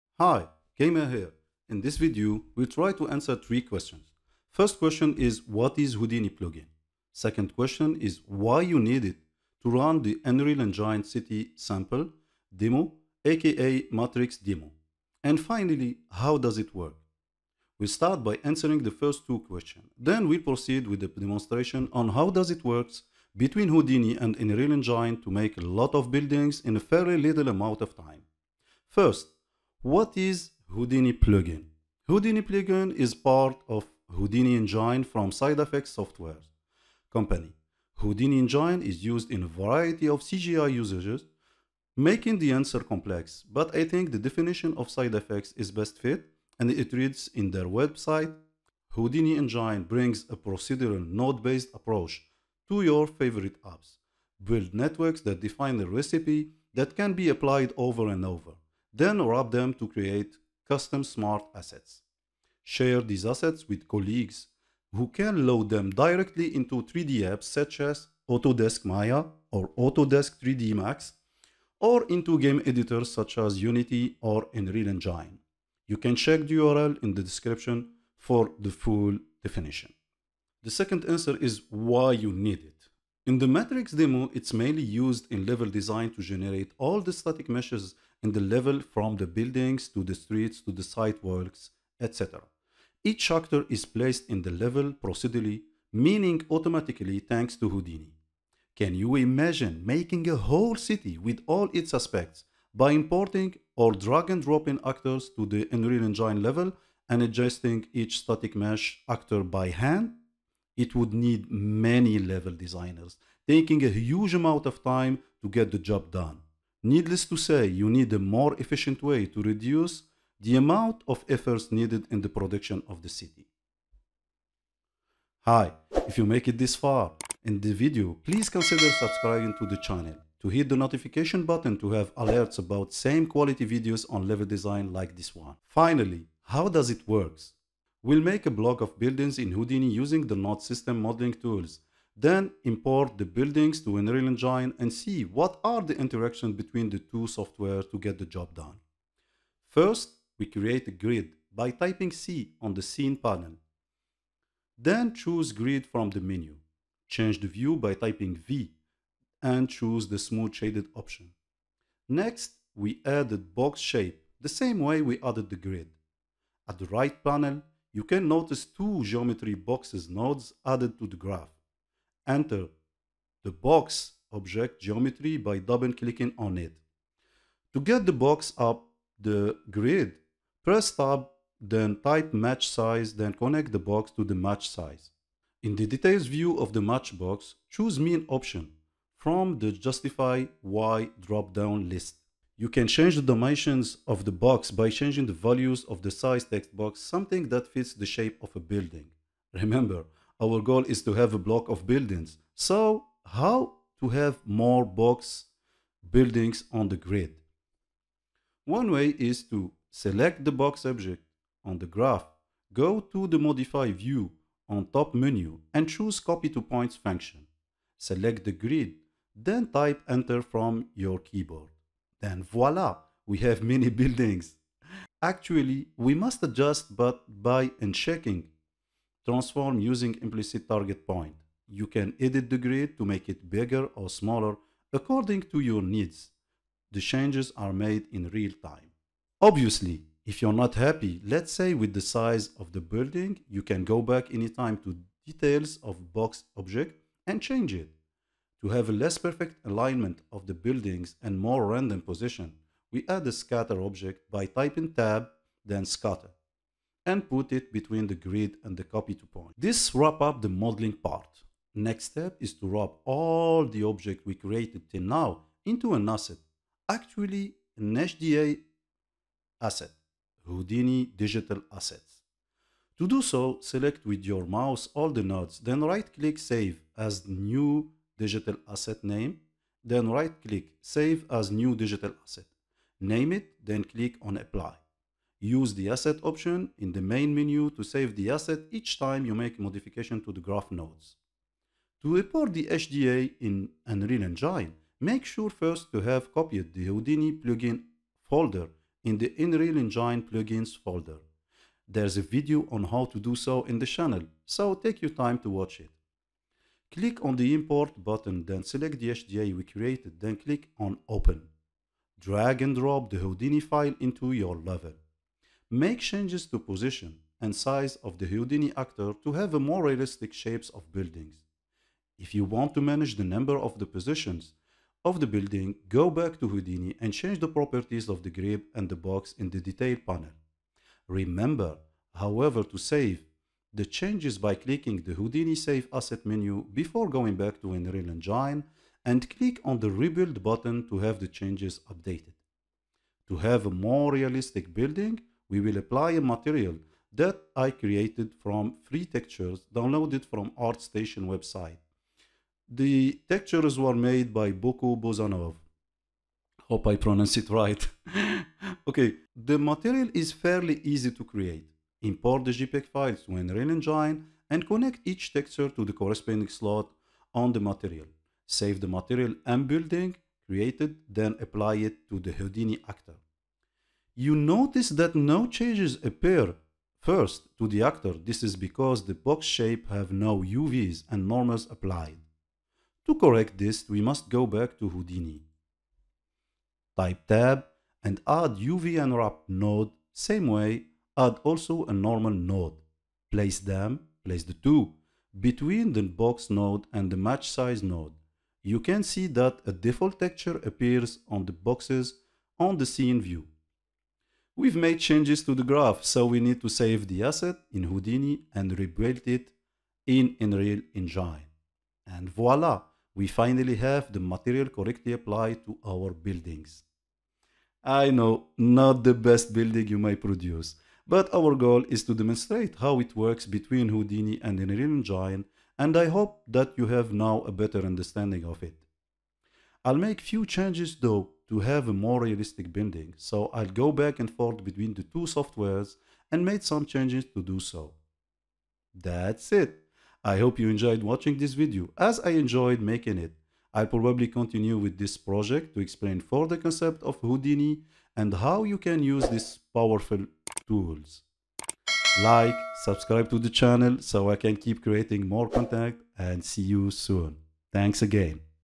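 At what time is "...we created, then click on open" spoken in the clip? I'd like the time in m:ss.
5:09.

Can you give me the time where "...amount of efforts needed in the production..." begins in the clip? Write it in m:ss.
2:00.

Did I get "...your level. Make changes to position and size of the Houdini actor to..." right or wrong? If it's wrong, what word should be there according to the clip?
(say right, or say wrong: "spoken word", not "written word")
right.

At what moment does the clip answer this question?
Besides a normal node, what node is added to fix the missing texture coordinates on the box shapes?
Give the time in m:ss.
6:28.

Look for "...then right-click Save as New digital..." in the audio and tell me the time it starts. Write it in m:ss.
4:35.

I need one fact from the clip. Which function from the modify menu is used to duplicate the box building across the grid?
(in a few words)
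copy to points.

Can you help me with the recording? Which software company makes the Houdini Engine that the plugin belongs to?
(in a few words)
Side Effects Software.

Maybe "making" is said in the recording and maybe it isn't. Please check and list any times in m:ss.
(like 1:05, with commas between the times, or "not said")
0:41, 1:39, 7:22.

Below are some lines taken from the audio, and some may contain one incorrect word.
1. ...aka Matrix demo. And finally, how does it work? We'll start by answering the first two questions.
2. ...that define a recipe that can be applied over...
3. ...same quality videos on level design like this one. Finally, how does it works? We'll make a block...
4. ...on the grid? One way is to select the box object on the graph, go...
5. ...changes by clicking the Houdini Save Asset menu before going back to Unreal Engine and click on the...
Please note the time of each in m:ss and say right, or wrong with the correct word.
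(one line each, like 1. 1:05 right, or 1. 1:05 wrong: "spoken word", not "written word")
1. 0:13 right
2. 0:55 right
3. 2:13 right
4. 3:26 right
5. 5:33 right.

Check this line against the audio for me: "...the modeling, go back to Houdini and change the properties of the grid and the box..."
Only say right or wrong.
wrong.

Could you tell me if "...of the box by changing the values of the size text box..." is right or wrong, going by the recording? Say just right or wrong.
right.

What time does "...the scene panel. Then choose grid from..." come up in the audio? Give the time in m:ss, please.
2:32.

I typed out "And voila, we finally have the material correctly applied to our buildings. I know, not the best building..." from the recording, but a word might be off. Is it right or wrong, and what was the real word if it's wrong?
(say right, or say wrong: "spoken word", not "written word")
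right.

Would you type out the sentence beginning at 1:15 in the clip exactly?
You can check the URL in the description for the full definition.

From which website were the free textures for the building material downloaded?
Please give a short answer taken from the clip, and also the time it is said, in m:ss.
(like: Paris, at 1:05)
ArtStation, at 5:50.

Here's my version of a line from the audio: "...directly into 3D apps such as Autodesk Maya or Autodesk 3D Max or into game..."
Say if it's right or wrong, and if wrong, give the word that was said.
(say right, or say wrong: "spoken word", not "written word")
right.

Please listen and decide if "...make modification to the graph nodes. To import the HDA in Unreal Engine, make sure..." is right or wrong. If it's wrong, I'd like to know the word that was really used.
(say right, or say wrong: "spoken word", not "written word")
right.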